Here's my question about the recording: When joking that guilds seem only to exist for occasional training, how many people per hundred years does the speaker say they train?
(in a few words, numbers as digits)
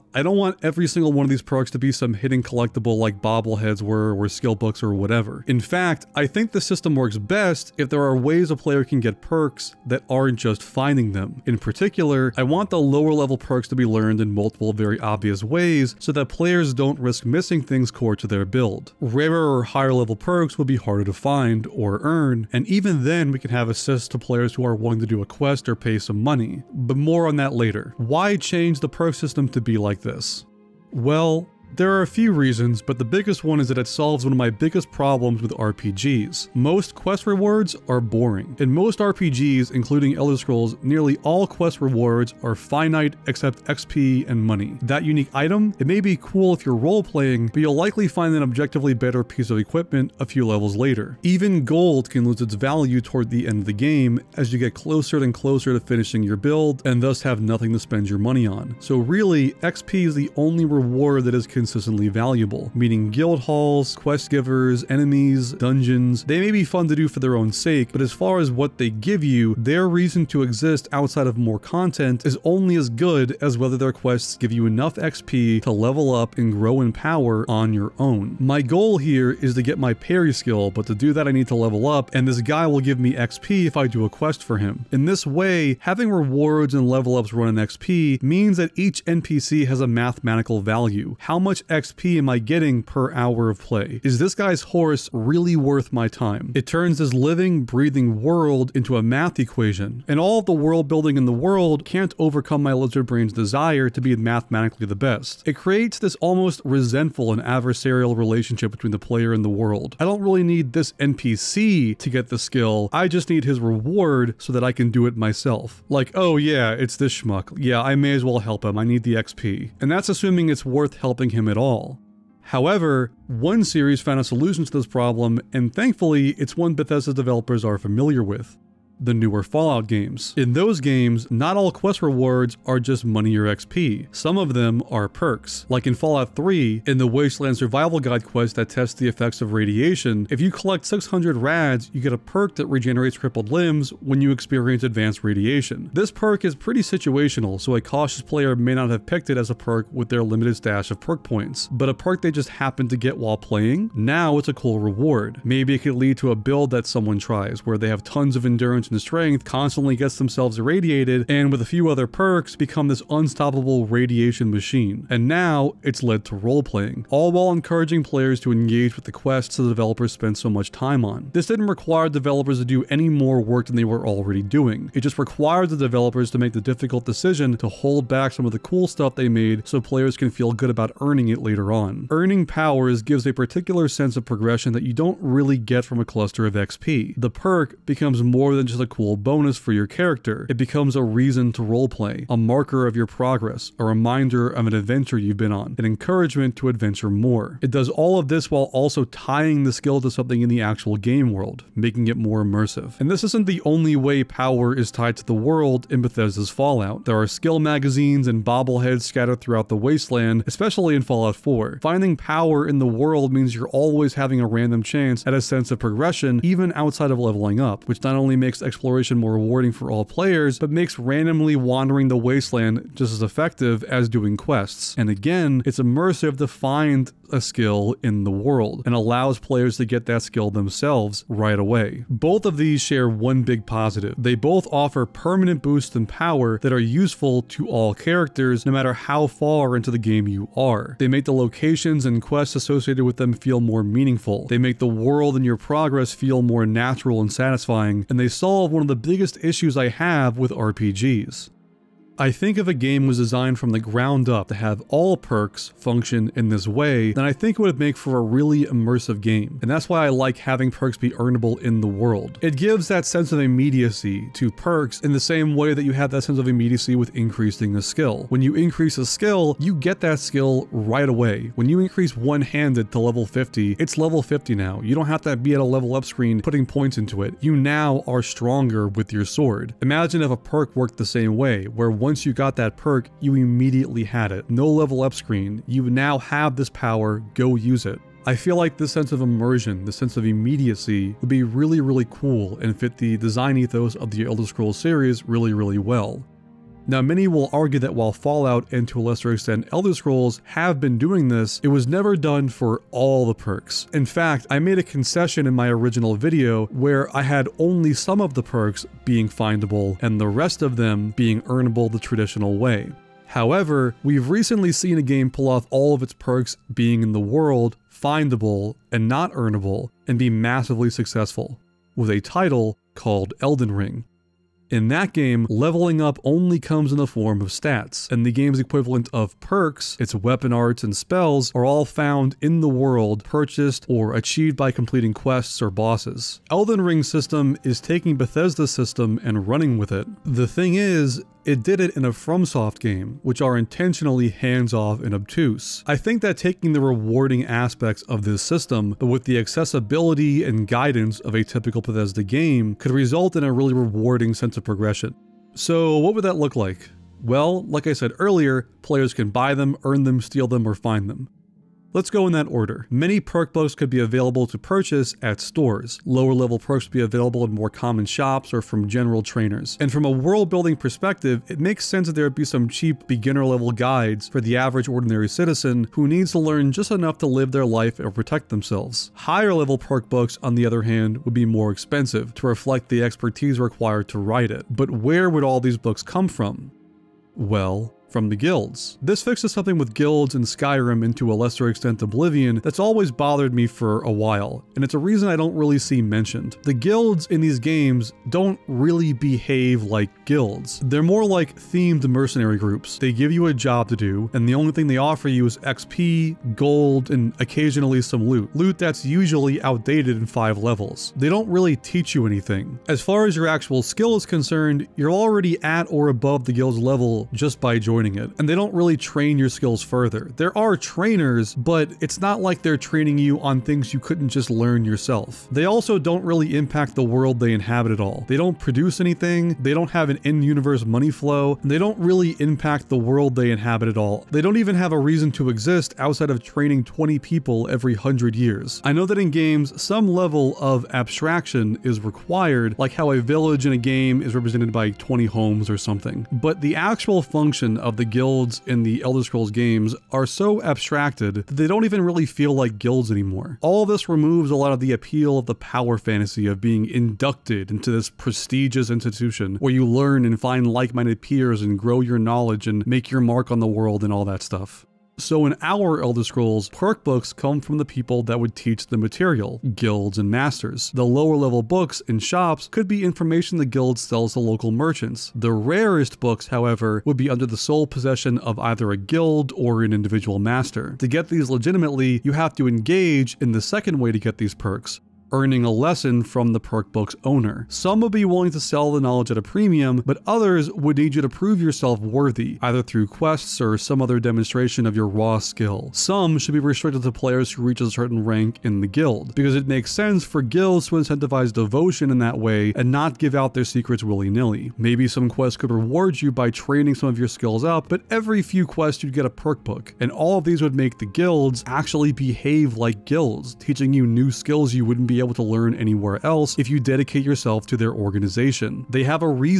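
20.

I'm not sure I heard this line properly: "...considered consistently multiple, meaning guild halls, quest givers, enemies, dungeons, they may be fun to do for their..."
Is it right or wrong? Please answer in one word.
wrong.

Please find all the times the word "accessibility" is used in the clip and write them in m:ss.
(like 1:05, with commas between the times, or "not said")
5:49.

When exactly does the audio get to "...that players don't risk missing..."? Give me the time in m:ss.
0:16.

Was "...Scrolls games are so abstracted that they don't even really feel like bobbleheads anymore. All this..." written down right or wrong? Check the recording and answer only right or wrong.
wrong.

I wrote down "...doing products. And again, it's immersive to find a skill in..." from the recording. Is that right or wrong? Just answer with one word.
wrong.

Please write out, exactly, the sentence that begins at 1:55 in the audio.
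Like, oh yeah, it's this schmuck.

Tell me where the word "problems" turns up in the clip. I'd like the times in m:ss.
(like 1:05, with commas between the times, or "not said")
0:34, 2:04.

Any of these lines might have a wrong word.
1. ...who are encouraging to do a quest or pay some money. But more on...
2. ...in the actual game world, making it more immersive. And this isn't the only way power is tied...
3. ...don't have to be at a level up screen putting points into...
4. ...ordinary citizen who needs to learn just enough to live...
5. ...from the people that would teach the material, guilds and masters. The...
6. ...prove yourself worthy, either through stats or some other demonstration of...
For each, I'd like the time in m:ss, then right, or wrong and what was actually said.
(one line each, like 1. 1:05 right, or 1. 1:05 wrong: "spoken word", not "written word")
1. 0:24 wrong: "willing", not "encouraging"
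2. 3:20 right
3. 4:34 right
4. 6:14 right
5. 7:47 right
6. 8:11 wrong: "quests", not "stats".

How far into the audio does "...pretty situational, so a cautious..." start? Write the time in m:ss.
2:26.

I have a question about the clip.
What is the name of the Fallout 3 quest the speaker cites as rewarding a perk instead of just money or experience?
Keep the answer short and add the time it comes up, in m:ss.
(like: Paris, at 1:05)
Wasteland Survival Guide, at 2:17.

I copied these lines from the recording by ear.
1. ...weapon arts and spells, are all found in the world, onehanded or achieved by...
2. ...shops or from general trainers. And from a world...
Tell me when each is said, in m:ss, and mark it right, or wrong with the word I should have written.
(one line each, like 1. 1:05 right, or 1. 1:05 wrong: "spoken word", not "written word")
1. 5:30 wrong: "purchased", not "onehanded"
2. 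6:08 right.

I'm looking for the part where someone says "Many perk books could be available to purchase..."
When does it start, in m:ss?
6:02.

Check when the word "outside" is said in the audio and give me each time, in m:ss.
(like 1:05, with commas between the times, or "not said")
1:10, 3:36, 7:15.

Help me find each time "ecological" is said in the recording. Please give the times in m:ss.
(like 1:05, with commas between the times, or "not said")
not said.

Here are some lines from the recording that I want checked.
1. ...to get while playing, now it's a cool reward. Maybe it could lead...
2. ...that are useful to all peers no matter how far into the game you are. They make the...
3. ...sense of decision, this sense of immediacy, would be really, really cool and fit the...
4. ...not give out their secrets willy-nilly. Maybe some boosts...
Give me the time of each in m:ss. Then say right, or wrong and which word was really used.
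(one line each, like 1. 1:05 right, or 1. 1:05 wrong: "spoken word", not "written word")
1. 2:32 right
2. 3:56 wrong: "characters", not "peers"
3. 4:48 wrong: "immersion", not "decision"
4. 8:22 wrong: "quests", not "boosts".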